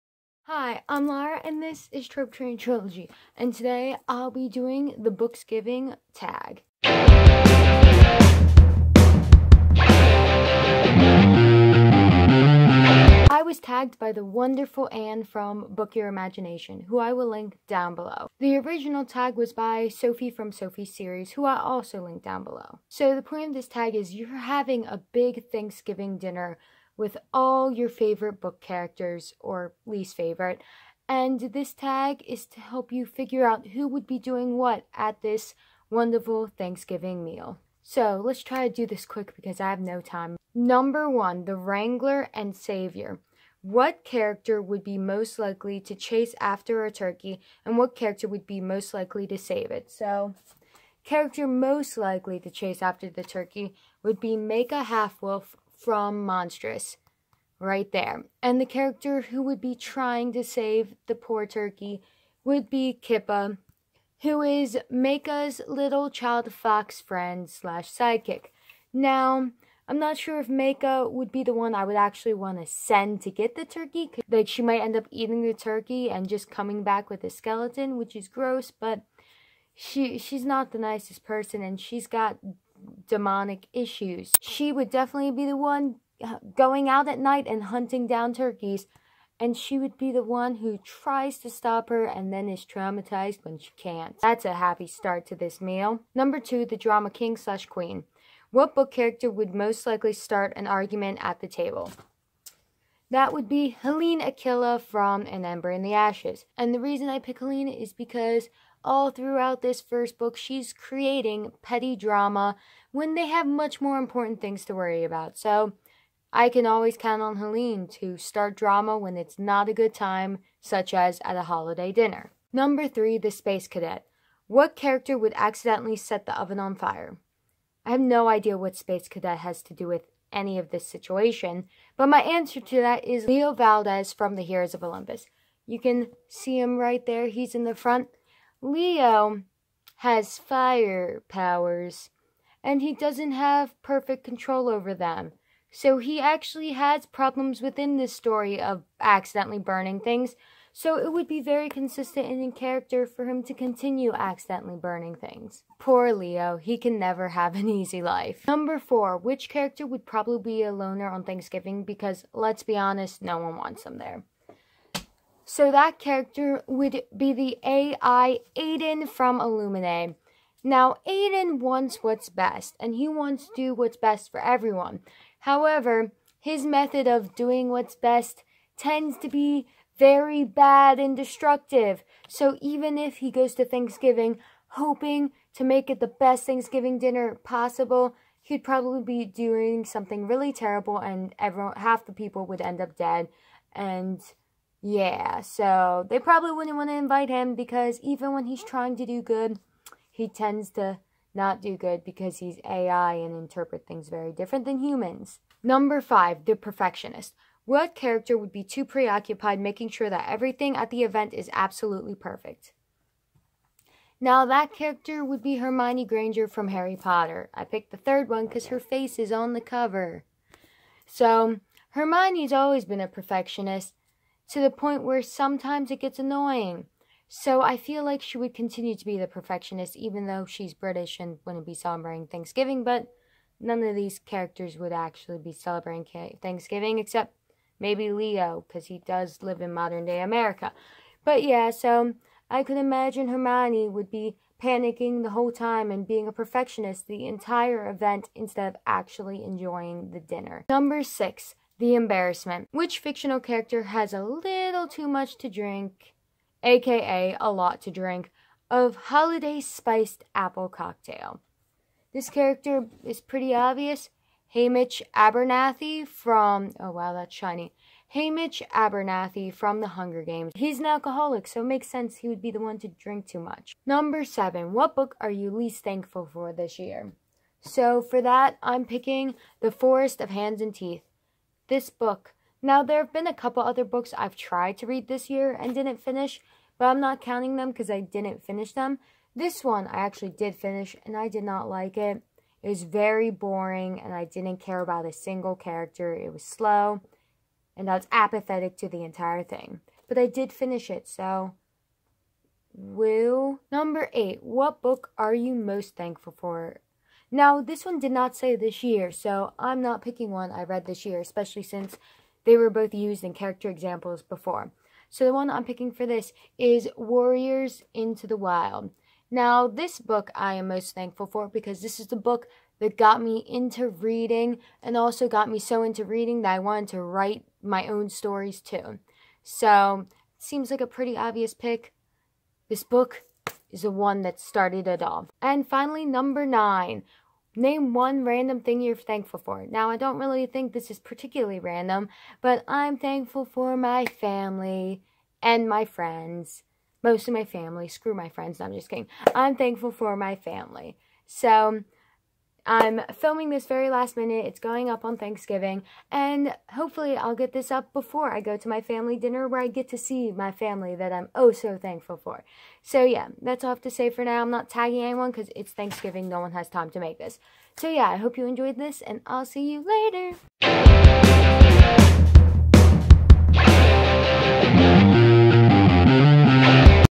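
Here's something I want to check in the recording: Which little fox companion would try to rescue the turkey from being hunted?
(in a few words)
Kippa.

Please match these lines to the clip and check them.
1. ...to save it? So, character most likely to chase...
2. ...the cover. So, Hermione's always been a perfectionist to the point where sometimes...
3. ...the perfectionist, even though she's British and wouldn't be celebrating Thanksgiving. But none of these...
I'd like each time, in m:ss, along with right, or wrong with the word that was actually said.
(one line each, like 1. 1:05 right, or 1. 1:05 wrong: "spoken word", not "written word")
1. 0:49 right
2. 3:39 right
3. 3:49 right.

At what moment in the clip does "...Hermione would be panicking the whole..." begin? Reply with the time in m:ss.
4:03.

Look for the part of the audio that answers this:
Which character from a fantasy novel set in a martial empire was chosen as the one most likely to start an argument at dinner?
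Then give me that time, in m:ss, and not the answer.
1:43.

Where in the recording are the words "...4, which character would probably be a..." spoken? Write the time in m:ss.
2:38.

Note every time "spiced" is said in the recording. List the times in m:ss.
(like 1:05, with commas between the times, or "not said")
4:19.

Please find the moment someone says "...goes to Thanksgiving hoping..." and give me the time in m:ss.
3:03.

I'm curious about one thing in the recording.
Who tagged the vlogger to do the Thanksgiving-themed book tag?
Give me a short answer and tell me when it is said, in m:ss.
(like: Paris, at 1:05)
Anne, at 0:14.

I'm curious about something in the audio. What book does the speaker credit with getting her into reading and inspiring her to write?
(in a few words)
Warriors: Into the Wild.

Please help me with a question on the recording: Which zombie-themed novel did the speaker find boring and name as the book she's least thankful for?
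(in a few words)
The Forest of Hands and Teeth.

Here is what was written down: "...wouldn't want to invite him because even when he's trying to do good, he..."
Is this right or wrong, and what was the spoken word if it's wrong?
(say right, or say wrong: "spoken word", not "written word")
right.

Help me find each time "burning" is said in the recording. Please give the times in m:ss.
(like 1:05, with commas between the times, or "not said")
2:29, 2:34.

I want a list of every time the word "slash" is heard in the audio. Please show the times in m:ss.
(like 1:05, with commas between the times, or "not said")
1:07, 1:37.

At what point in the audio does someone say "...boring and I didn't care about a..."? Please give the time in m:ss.
4:53.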